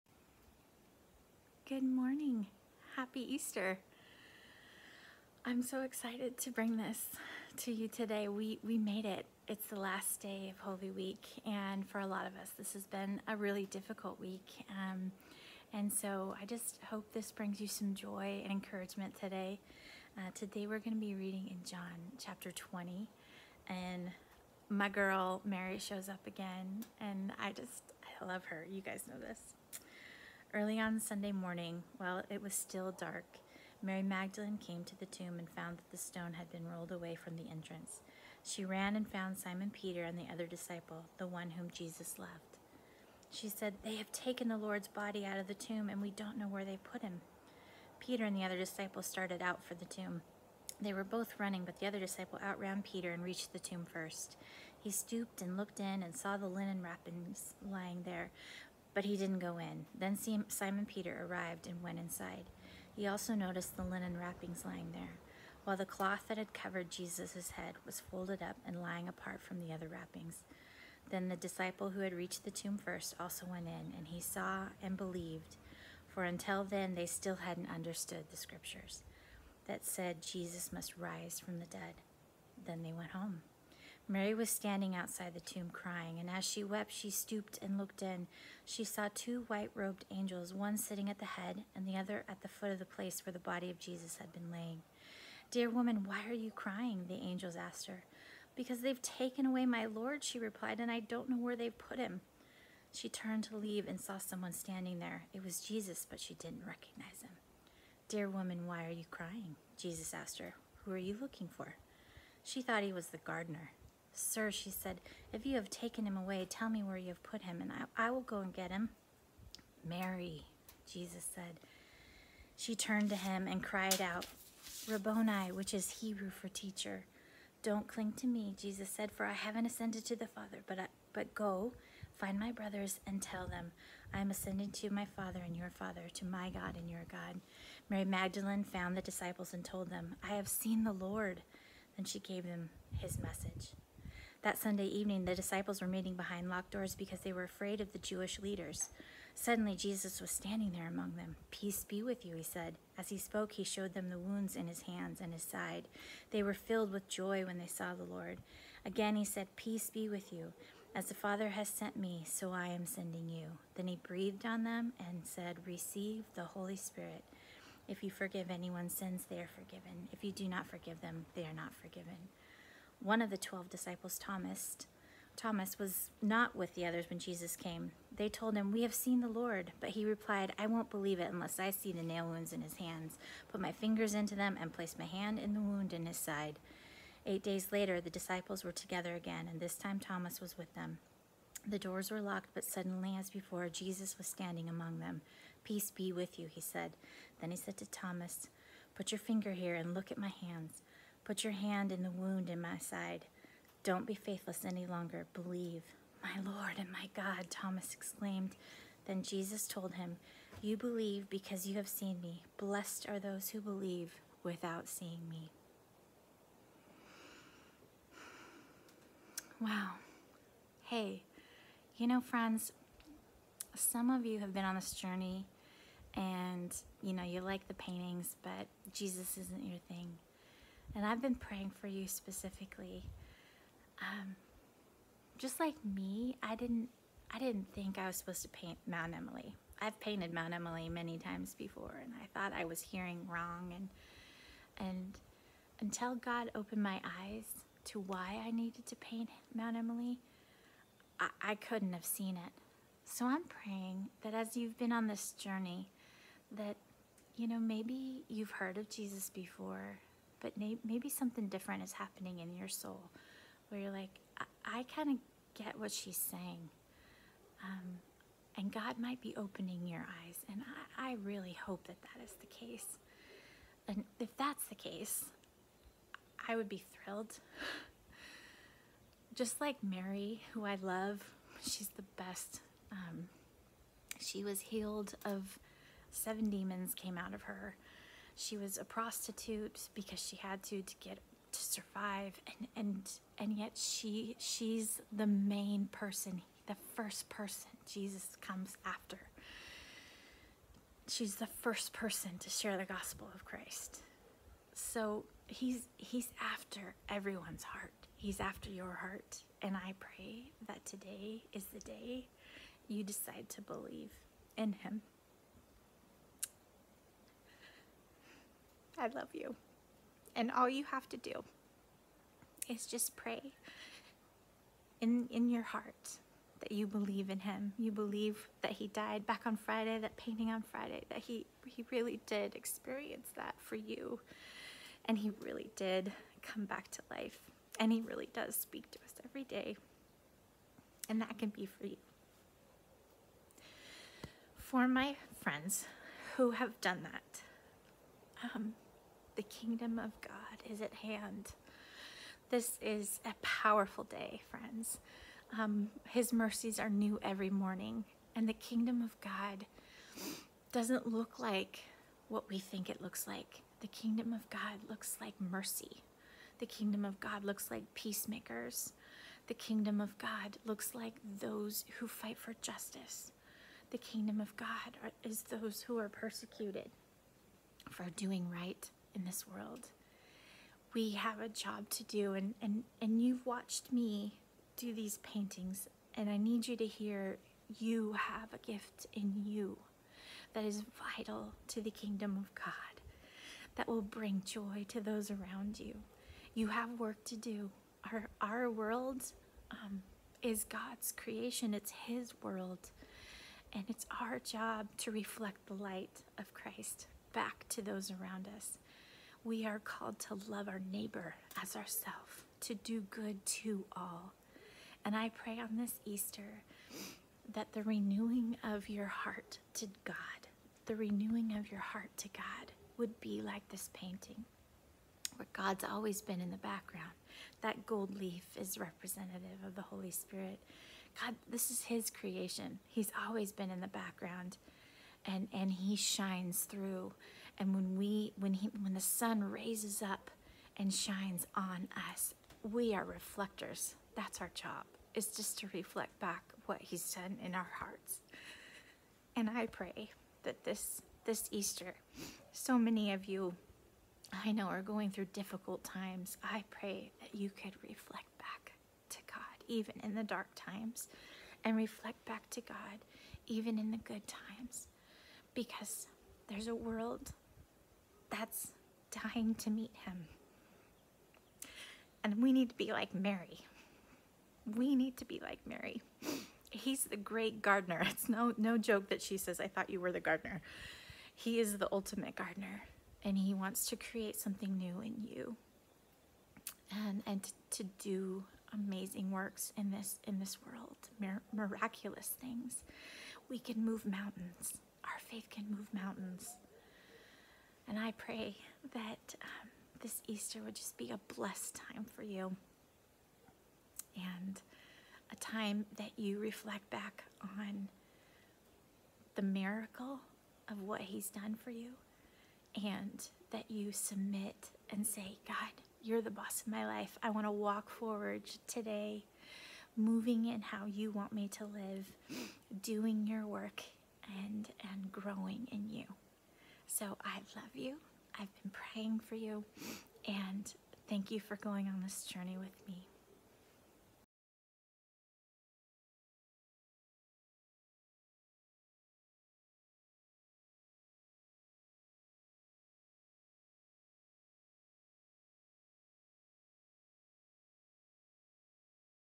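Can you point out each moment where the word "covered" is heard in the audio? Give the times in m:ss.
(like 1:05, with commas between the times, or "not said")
1:06.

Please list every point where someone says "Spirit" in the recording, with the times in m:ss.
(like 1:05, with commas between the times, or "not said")
2:46, 7:10.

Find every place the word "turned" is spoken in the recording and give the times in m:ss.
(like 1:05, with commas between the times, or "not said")
1:43, 2:02.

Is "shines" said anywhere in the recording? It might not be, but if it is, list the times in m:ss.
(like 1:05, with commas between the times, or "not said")
7:15, 7:20.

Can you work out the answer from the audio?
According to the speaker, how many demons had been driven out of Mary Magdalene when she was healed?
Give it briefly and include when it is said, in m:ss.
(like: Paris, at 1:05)
7, at 4:46.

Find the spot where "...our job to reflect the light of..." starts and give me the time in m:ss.
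6:44.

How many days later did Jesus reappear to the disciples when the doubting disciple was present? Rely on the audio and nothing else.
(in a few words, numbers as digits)
8.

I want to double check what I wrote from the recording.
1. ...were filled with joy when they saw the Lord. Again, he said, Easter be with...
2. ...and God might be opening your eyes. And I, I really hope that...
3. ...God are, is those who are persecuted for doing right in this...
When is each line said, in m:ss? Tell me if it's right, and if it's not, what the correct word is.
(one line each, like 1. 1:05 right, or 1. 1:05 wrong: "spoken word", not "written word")
1. 2:36 wrong: "Peace", not "Easter"
2. 4:28 right
3. 6:14 right.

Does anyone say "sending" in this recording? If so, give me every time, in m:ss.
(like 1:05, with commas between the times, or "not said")
2:42.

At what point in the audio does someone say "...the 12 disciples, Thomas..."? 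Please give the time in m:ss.
2:53.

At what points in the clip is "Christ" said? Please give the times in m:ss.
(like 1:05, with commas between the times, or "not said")
5:03, 6:46.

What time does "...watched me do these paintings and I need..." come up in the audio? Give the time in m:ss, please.
6:23.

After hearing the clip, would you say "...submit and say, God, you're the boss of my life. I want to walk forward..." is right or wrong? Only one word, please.
right.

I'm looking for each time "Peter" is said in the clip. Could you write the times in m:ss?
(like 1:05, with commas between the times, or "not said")
0:39, 0:48, 0:52, 1:00.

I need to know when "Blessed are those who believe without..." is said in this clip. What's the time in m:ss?
3:32.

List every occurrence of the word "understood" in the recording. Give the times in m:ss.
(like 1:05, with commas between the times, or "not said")
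1:17.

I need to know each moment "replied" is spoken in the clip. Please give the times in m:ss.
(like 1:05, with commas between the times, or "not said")
1:40, 3:00.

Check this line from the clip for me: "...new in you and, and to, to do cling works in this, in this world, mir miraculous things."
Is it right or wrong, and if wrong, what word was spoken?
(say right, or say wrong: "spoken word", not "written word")
wrong: "amazing", not "cling".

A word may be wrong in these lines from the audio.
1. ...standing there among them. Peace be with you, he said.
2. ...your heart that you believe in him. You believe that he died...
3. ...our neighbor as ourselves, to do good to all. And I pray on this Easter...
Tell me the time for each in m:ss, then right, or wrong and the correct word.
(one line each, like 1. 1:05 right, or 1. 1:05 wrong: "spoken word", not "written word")
1. 2:30 right
2. 5:25 right
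3. 6:50 right.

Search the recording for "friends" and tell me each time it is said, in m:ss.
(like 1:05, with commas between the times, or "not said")
3:42, 5:45, 5:54.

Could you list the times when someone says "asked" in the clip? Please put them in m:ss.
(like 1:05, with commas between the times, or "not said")
1:37, 1:50.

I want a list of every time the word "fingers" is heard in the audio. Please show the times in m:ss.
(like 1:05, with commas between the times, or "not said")
3:03, 3:19.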